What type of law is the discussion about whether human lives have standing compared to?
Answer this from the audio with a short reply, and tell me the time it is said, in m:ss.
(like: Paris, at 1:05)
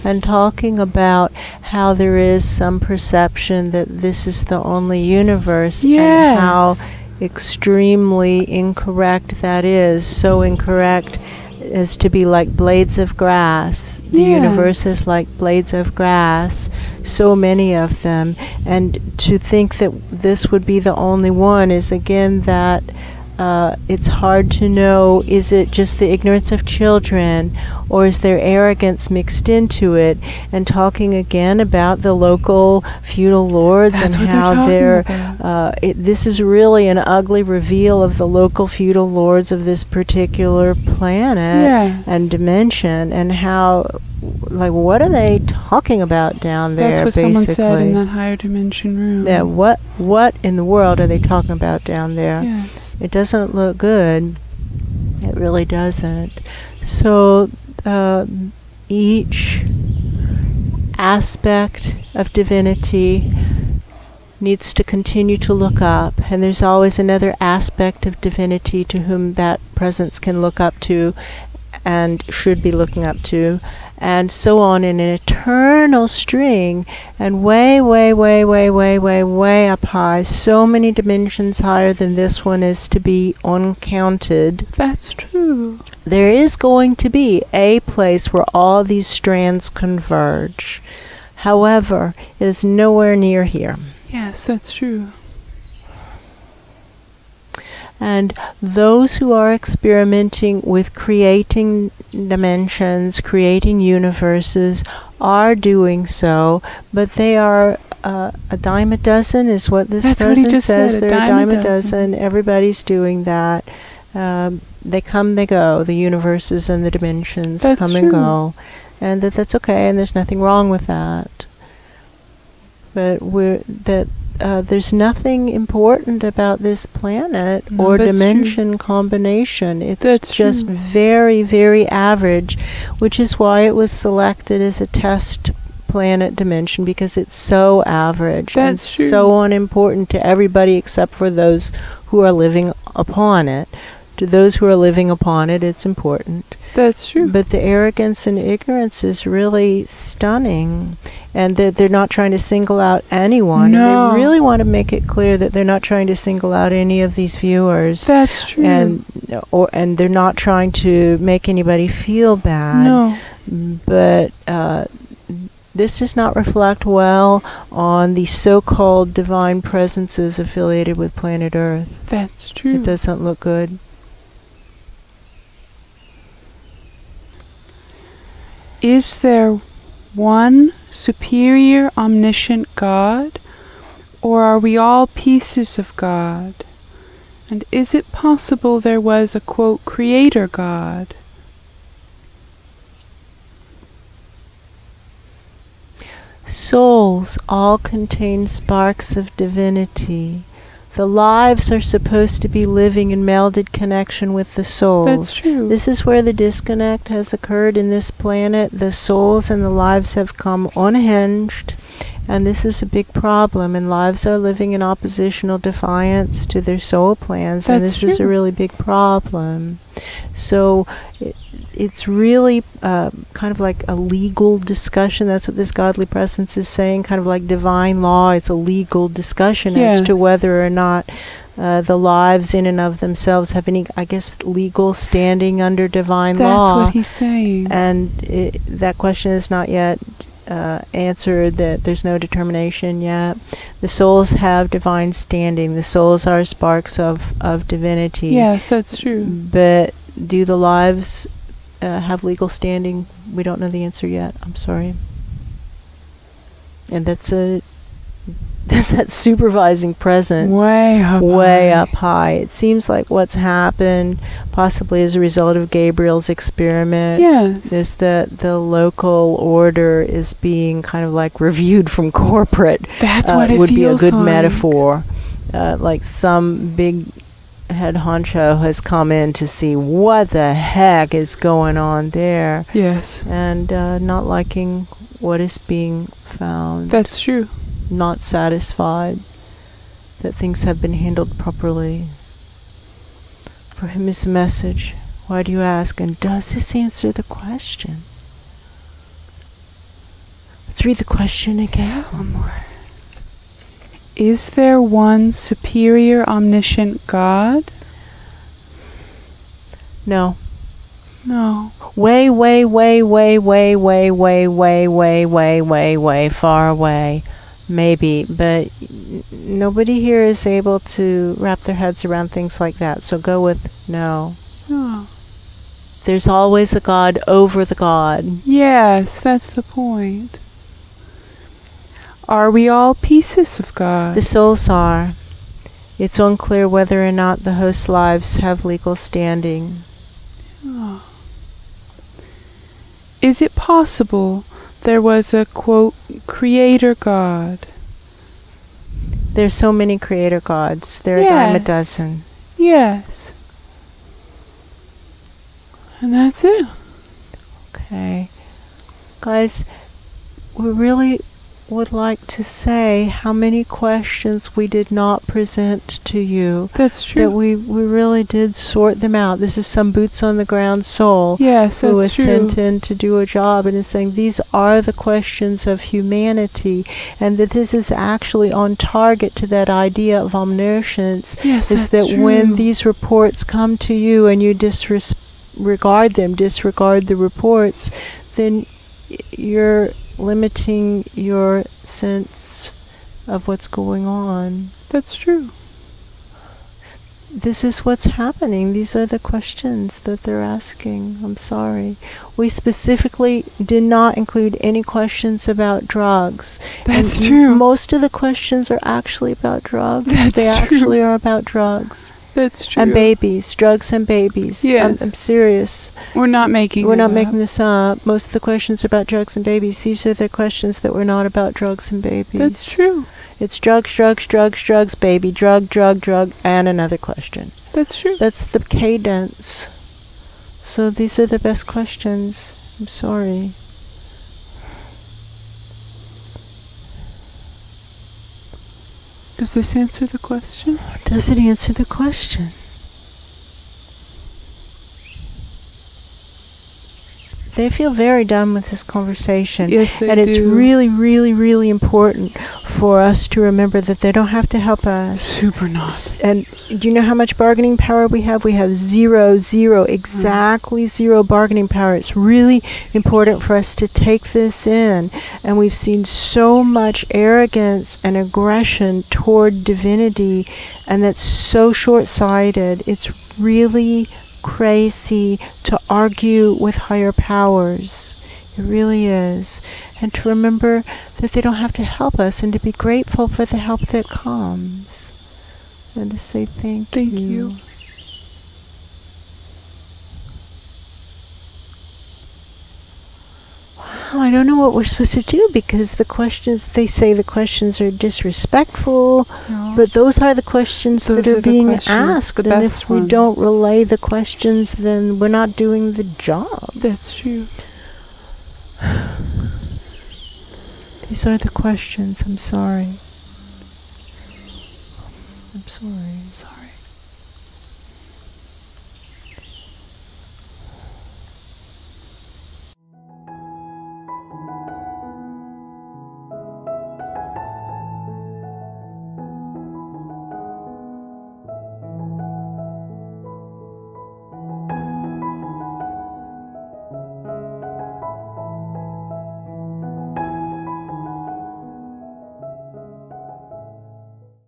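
divine law, at 3:47.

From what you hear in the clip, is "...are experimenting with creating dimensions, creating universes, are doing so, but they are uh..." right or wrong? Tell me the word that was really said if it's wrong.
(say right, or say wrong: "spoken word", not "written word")
right.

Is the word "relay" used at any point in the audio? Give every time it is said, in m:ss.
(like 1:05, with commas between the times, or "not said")
8:23.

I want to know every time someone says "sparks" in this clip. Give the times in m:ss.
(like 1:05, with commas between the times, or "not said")
3:18, 4:06.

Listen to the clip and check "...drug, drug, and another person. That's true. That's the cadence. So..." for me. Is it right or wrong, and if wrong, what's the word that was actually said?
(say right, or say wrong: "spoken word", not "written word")
wrong: "question", not "person".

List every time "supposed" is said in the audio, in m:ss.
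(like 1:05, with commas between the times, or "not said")
3:21, 8:14.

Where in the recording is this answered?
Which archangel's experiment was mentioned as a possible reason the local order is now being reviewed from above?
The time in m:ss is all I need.
4:25.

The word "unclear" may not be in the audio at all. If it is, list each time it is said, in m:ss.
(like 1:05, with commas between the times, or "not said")
5:36.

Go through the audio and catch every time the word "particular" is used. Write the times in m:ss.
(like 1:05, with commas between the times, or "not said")
0:39.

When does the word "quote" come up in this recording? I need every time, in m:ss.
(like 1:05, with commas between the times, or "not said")
3:09, 5:45.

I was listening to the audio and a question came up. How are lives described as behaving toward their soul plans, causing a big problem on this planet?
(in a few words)
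oppositional defiance.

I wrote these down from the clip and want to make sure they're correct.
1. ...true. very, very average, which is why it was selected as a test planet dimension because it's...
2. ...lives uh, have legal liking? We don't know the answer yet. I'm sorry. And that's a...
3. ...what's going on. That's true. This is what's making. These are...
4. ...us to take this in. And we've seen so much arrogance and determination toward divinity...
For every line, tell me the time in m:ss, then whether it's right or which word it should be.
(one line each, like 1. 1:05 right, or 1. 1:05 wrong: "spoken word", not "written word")
1. 2:10 right
2. 4:10 wrong: "standing", not "liking"
3. 6:33 wrong: "happening", not "making"
4. 7:43 wrong: "aggression", not "determination".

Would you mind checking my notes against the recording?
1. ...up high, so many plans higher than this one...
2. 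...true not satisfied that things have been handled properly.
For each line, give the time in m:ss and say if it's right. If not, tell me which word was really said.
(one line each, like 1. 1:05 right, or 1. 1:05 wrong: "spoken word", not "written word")
1. 1:19 wrong: "dimensions", not "plans"
2. 4:47 right.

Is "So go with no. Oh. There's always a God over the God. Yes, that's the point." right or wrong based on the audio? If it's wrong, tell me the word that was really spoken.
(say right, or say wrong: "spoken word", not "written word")
right.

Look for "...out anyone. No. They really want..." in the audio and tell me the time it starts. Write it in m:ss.
2:32.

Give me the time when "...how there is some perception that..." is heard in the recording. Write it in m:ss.
0:01.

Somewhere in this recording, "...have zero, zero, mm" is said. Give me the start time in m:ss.
7:38.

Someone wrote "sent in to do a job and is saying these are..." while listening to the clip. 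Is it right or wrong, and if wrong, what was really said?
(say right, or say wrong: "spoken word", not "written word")
right.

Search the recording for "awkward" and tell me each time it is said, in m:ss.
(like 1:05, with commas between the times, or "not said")
not said.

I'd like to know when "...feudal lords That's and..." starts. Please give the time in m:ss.
0:33.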